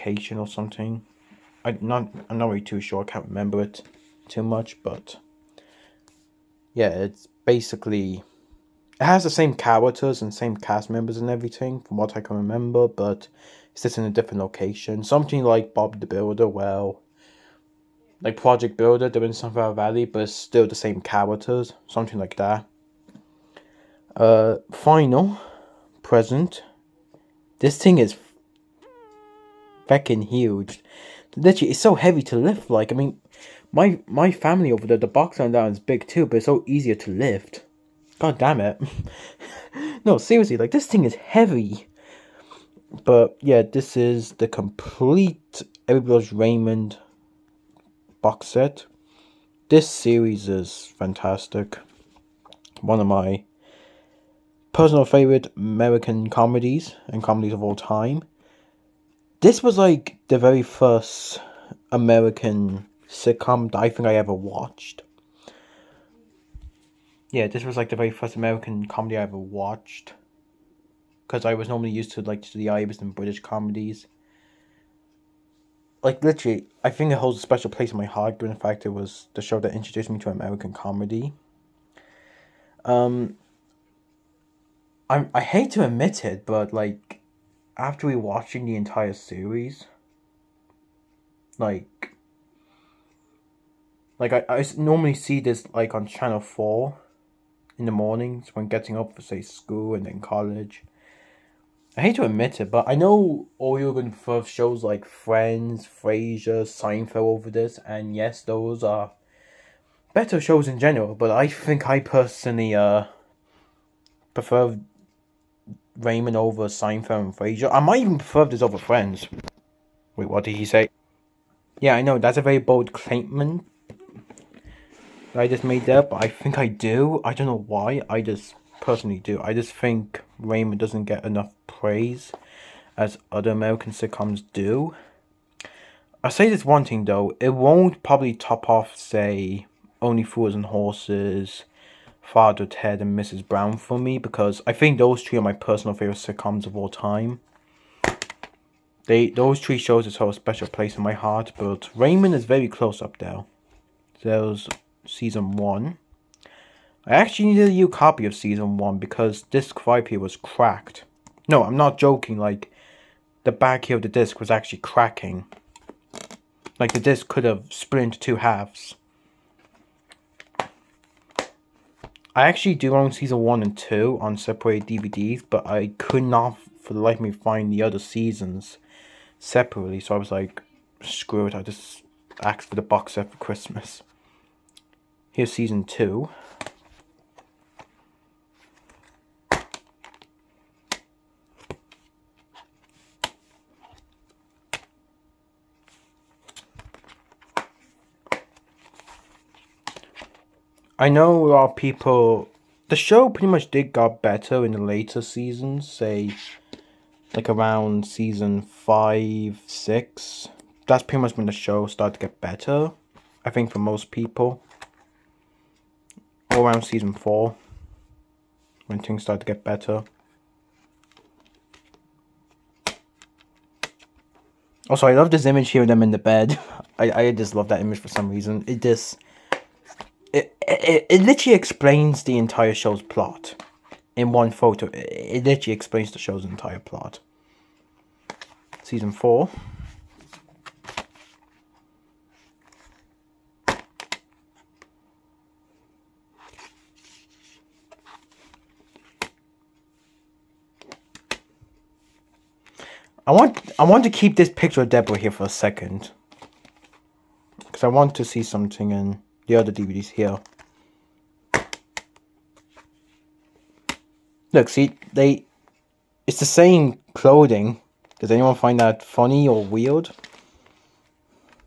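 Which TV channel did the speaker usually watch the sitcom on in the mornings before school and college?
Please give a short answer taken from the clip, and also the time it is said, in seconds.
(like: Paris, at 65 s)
Channel 4, at 96 s.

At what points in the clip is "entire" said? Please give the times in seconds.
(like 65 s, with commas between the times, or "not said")
88 s, 232 s, 236 s.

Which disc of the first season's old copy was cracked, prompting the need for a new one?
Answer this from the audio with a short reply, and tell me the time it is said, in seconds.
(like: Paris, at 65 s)
Disc 5, at 159 s.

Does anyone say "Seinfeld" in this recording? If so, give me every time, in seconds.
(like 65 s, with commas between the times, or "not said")
106 s, 116 s.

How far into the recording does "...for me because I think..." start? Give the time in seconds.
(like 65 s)
143 s.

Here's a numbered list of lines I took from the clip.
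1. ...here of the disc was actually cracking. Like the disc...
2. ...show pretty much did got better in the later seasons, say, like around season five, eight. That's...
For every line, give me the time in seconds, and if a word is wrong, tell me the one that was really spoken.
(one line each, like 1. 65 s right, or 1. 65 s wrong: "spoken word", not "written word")
1. 163 s right
2. 202 s wrong: "six", not "eight".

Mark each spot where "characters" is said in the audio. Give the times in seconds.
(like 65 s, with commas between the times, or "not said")
9 s, 21 s.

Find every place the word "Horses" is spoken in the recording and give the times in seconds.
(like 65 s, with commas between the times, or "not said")
140 s.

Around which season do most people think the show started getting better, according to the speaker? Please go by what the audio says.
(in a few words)
Season 4.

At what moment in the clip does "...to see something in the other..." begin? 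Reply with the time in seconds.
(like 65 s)
258 s.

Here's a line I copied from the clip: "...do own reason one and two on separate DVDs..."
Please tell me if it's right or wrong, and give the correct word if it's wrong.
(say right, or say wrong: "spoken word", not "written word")
wrong: "season", not "reason".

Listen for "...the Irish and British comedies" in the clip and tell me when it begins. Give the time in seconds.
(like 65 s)
72 s.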